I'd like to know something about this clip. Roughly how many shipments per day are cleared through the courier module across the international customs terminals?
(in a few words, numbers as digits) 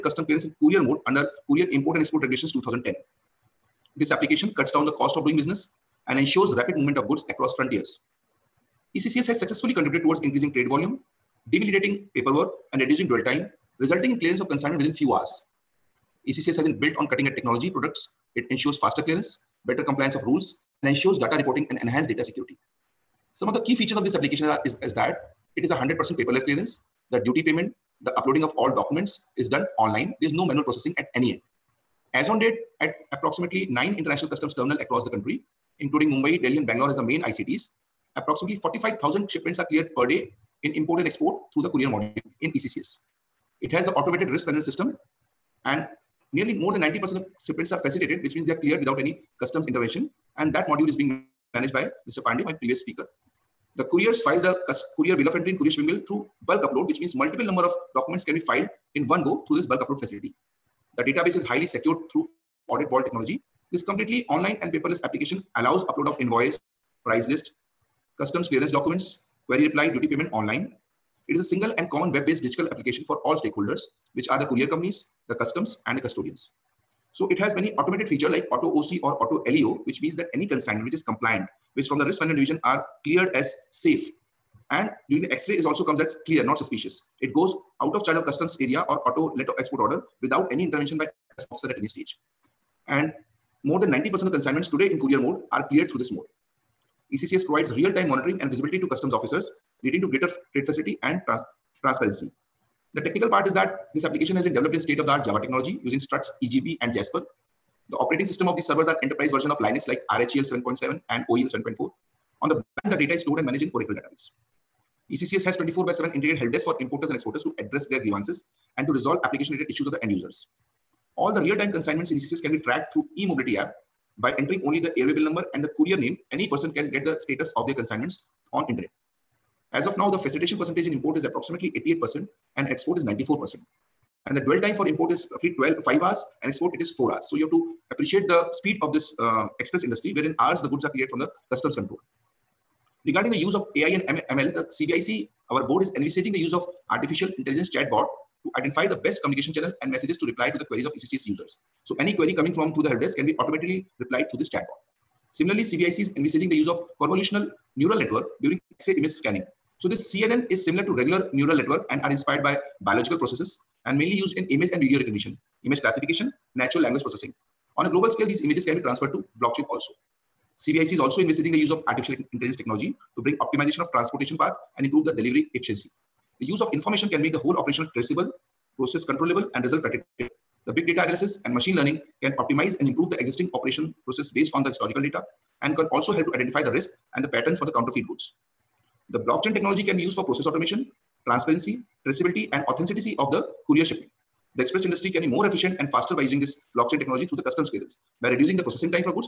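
45,000.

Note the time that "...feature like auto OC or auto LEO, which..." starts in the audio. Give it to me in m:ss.
1:18.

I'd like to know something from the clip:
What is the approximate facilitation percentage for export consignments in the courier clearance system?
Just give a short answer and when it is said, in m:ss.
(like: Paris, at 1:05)
94%, at 2:13.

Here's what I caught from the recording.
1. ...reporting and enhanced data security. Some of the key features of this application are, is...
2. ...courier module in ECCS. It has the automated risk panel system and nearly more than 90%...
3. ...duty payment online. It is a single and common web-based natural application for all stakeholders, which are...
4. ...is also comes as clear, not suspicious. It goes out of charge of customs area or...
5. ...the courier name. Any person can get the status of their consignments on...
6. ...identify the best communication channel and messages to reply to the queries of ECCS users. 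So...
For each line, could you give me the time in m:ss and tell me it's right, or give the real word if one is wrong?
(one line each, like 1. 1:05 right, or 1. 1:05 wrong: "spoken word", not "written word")
1. 0:21 right
2. 0:41 right
3. 1:09 wrong: "digital", not "natural"
4. 1:25 right
5. 2:05 right
6. 2:28 right.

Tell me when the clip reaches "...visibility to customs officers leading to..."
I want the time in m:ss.
1:38.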